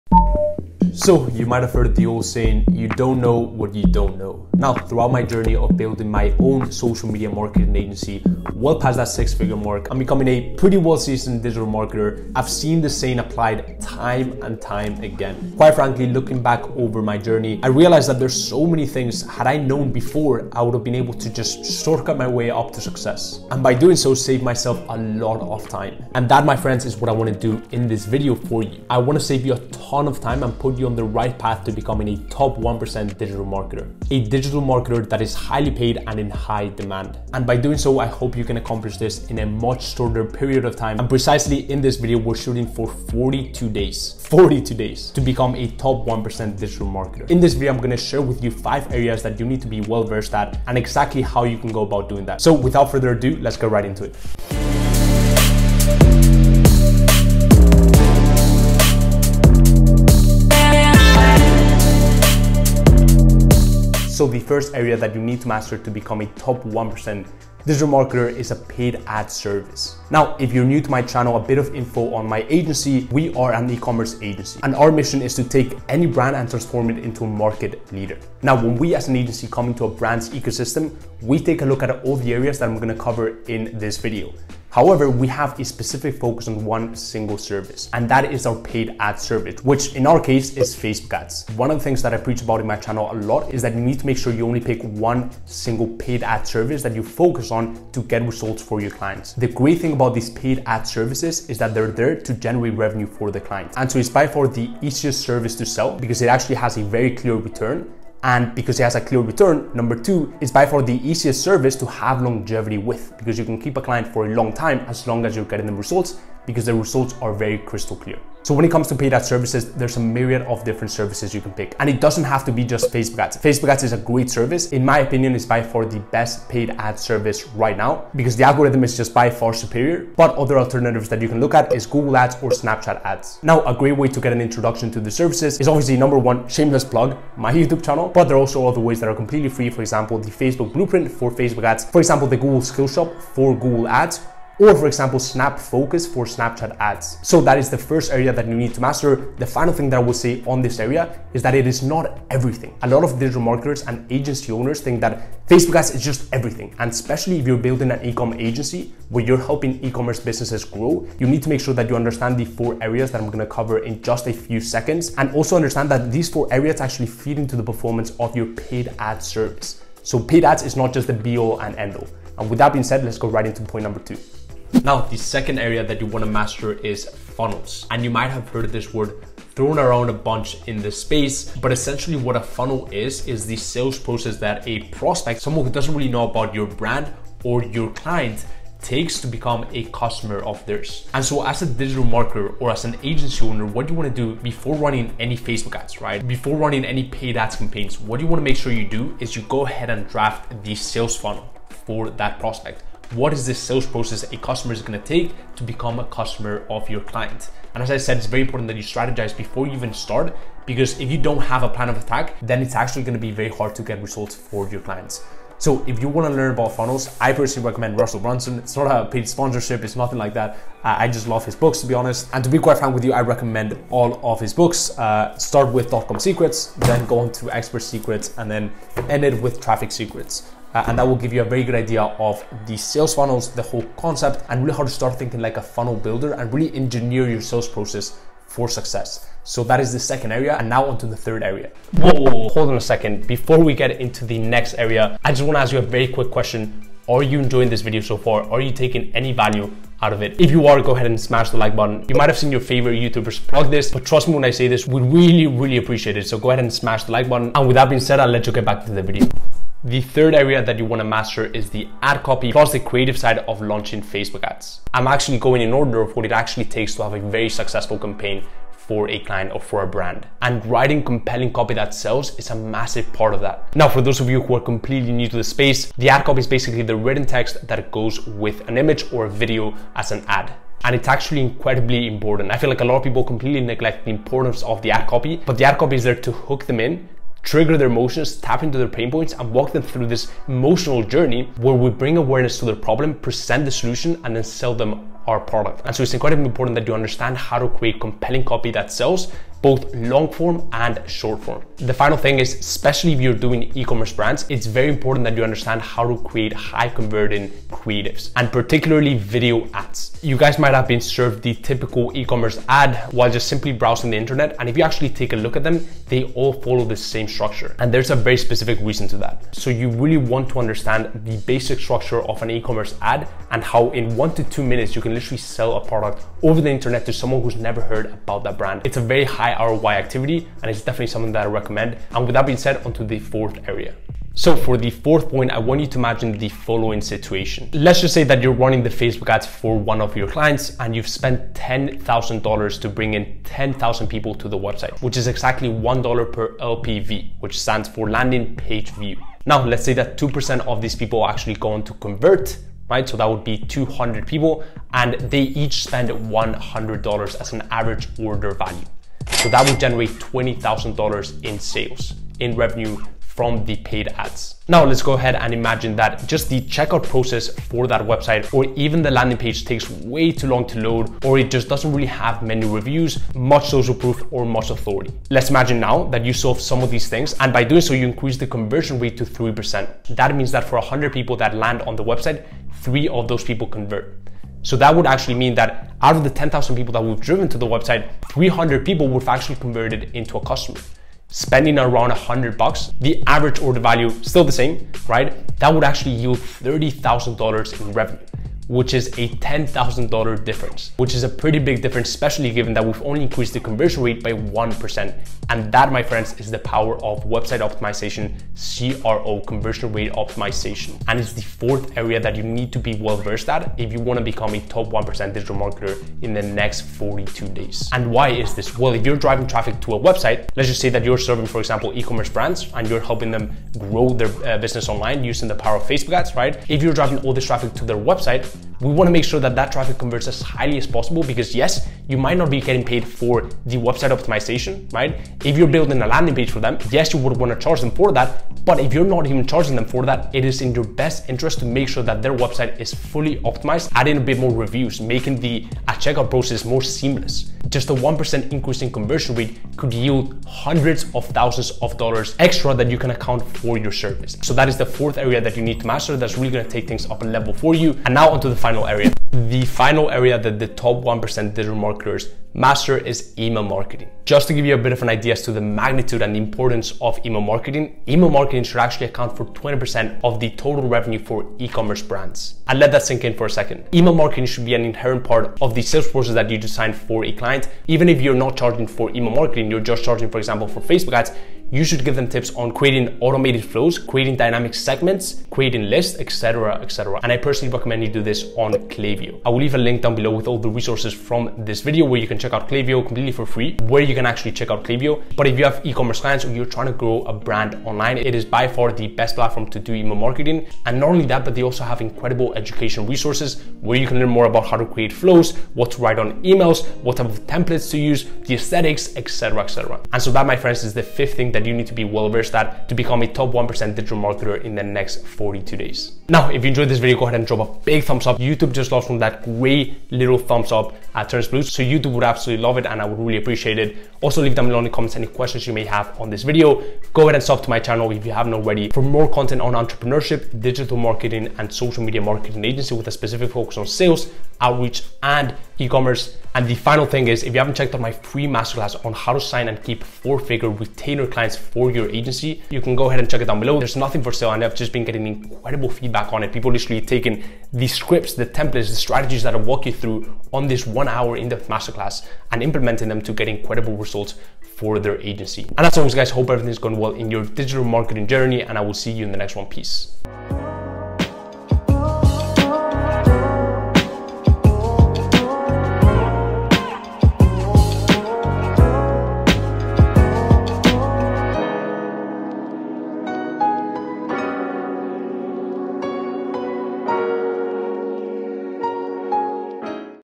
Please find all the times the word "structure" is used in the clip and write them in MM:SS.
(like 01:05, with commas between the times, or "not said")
05:17, 05:21.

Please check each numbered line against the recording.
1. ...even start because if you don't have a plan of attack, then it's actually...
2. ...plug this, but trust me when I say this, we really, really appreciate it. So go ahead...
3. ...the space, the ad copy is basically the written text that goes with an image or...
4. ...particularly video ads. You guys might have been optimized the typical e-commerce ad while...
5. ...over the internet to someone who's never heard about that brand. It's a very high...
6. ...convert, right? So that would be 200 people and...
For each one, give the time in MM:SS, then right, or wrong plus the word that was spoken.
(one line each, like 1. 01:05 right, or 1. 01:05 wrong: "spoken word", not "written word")
1. 03:29 right
2. 04:13 right
3. 04:35 right
4. 05:08 wrong: "served", not "optimized"
5. 05:26 right
6. 05:51 right.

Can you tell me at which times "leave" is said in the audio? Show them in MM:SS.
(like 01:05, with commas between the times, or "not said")
08:09, 08:44.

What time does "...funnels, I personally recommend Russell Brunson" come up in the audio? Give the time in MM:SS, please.
03:36.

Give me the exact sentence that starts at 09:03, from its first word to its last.
There's nothing for sale and I've just been getting incredible feedback on it.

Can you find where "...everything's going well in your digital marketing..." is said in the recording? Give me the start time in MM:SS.
09:16.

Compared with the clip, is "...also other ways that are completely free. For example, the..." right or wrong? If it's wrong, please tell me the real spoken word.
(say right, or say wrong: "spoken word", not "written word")
right.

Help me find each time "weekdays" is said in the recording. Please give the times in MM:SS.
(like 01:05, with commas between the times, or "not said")
not said.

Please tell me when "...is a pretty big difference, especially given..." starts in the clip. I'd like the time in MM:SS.
06:41.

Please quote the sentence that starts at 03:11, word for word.
And so as a digital marketer or as an agency owner, what you wanna do before running any Facebook ads, right?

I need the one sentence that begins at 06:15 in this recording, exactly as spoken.
Let's imagine now that you solve some of these things and by doing so you increase the conversion rate to 3%.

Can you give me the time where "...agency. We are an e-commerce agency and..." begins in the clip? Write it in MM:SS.
01:12.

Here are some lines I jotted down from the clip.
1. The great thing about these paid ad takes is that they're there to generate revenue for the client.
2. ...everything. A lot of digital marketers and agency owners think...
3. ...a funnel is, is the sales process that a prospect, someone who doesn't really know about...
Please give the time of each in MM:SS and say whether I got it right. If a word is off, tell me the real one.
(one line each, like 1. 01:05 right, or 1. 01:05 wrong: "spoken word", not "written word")
1. 01:39 wrong: "services", not "takes"
2. 02:32 right
3. 03:02 right.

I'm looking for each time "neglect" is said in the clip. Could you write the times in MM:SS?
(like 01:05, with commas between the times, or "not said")
04:43.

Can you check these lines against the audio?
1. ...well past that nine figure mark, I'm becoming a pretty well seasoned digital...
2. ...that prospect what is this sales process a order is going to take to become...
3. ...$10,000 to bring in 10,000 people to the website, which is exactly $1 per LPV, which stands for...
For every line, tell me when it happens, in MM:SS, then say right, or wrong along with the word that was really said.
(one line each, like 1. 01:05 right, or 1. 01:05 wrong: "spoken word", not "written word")
1. 00:08 wrong: "six", not "nine"
2. 03:22 wrong: "customer", not "order"
3. 05:41 right.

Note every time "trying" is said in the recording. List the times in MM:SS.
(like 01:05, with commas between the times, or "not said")
08:16.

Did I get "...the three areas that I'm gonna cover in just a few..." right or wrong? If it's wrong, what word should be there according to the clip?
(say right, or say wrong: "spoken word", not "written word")
wrong: "four", not "three".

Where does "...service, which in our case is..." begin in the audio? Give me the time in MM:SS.
01:29.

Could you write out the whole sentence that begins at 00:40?
And precisely in this video, we're shooting for 42 days, 42 days to become a top 1% digital marketer.